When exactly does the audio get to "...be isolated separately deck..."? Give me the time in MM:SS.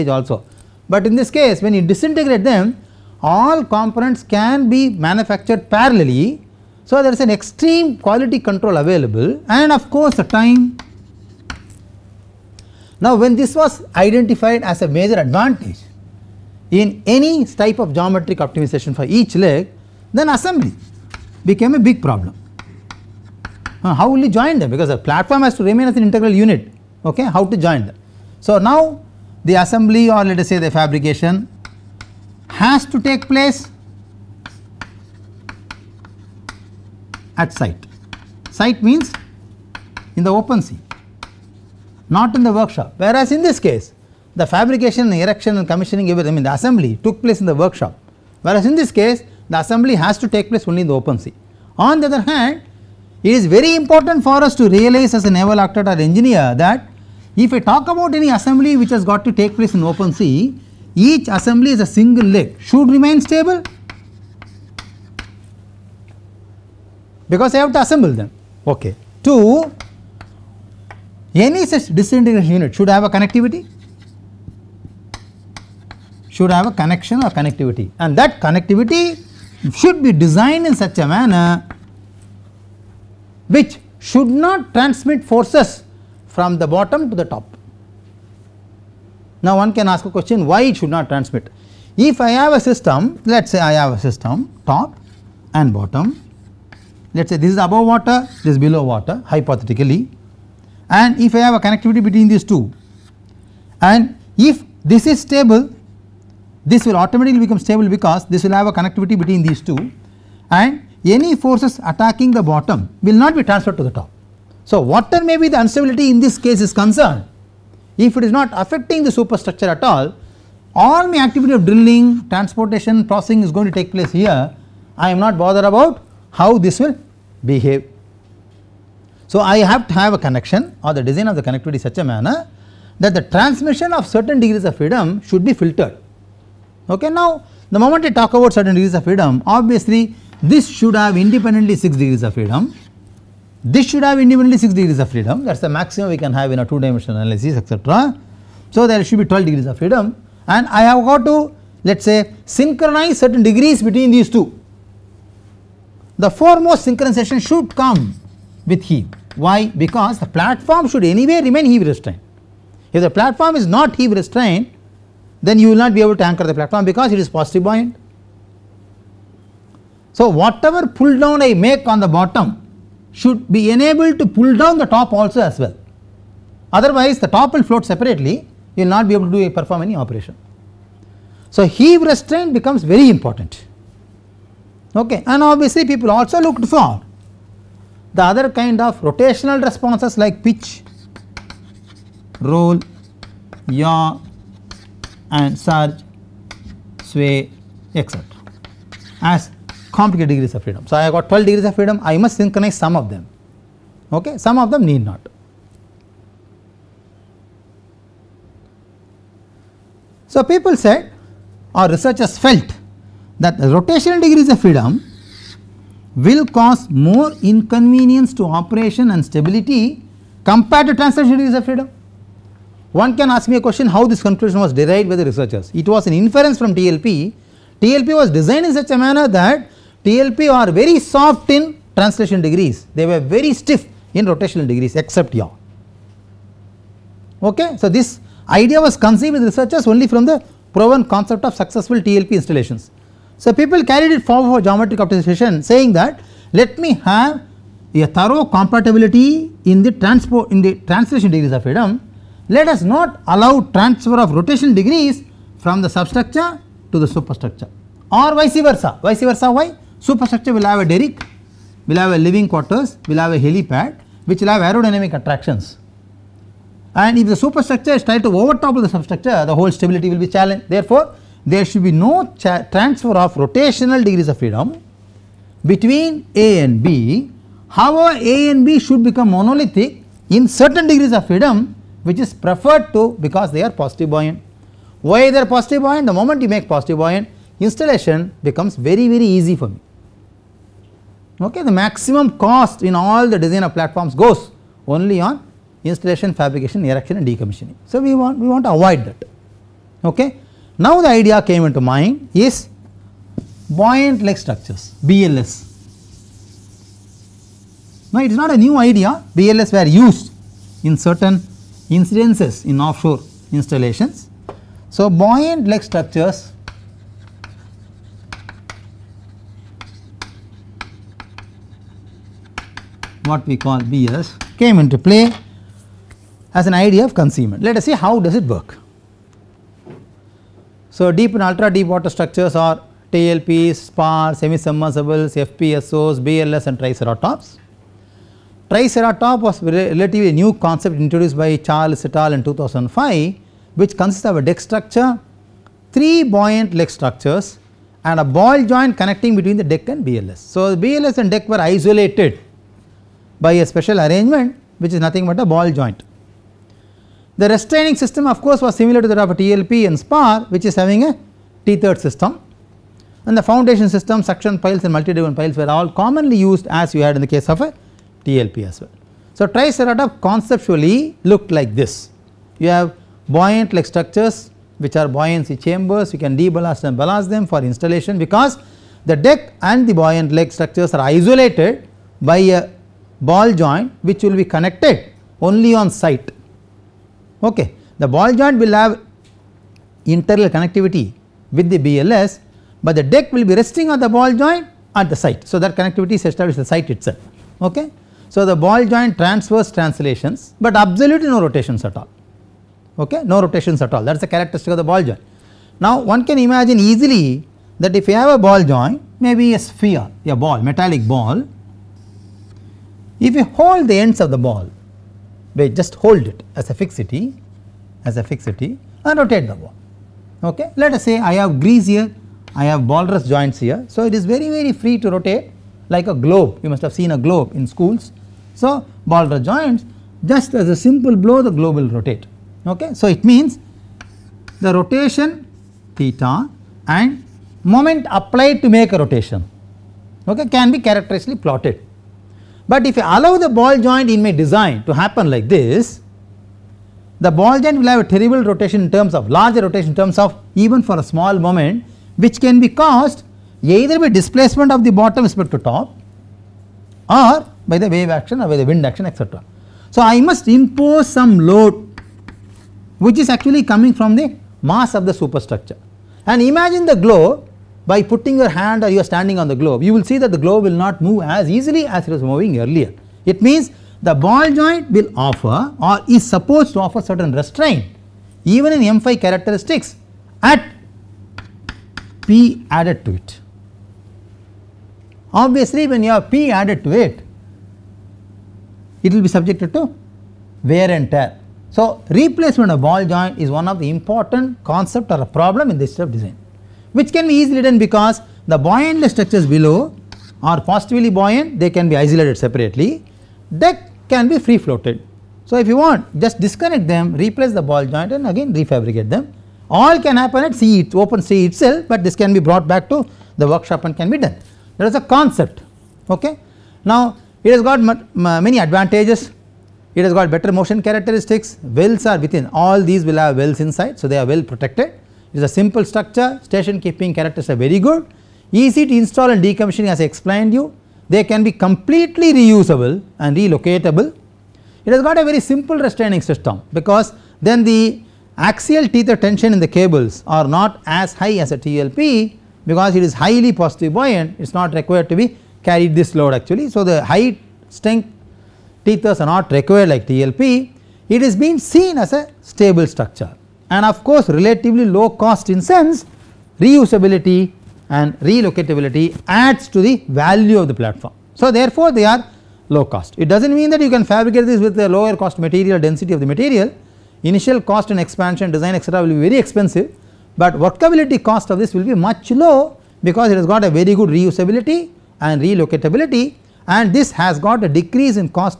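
08:21.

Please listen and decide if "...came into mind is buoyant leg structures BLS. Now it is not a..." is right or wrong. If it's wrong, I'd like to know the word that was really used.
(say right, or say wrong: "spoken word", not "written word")
right.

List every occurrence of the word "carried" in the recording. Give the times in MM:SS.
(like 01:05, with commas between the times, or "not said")
04:03, 09:05.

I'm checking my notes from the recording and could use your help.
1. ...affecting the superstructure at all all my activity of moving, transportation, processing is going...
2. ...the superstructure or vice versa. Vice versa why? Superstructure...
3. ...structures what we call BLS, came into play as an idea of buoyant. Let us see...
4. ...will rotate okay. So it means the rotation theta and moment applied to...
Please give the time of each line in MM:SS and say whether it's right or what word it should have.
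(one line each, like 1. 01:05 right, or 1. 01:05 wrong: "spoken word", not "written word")
1. 01:58 wrong: "drilling", not "moving"
2. 04:16 right
3. 05:15 wrong: "concealment", not "buoyant"
4. 07:11 right.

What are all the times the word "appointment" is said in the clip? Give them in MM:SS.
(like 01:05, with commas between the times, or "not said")
not said.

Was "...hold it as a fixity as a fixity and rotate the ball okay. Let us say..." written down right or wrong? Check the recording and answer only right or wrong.
right.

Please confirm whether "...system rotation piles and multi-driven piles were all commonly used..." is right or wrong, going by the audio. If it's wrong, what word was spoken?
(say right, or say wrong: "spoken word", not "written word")
wrong: "suction", not "rotation".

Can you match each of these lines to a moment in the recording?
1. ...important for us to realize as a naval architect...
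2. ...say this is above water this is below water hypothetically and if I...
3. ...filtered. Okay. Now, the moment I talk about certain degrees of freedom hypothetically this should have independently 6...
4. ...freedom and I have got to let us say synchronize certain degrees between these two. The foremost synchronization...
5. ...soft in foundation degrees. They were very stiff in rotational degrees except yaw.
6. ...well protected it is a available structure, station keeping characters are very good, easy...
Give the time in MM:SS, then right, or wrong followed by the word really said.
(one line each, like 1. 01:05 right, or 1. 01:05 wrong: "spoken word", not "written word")
1. 00:53 right
2. 01:37 right
3. 02:15 wrong: "obviously", not "hypothetically"
4. 02:29 right
5. 03:50 wrong: "translation", not "foundation"
6. 08:44 wrong: "simple", not "available".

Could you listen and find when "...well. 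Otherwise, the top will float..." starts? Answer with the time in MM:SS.
02:55.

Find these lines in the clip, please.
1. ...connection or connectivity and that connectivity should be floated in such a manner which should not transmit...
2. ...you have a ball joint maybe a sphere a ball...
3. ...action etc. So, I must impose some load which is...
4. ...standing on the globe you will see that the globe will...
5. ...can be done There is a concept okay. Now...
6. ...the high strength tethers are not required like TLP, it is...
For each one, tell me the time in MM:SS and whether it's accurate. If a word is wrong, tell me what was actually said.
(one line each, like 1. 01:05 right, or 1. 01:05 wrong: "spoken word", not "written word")
1. 01:16 wrong: "designed", not "floated"
2. 06:48 right
3. 07:38 right
4. 07:49 right
5. 08:33 right
6. 09:06 right.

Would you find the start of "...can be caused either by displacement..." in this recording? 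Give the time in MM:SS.
07:32.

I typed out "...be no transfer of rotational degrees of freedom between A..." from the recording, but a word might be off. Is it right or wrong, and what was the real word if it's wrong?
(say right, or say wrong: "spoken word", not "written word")
right.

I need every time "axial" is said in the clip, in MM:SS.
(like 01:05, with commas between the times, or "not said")
08:58.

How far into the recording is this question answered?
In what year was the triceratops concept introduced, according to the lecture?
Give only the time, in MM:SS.
05:42.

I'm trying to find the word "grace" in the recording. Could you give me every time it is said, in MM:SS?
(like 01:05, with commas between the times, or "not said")
not said.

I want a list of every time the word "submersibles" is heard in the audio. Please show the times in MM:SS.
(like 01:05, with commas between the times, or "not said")
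05:34.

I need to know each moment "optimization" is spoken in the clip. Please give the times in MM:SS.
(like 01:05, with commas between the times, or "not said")
00:18, 04:04.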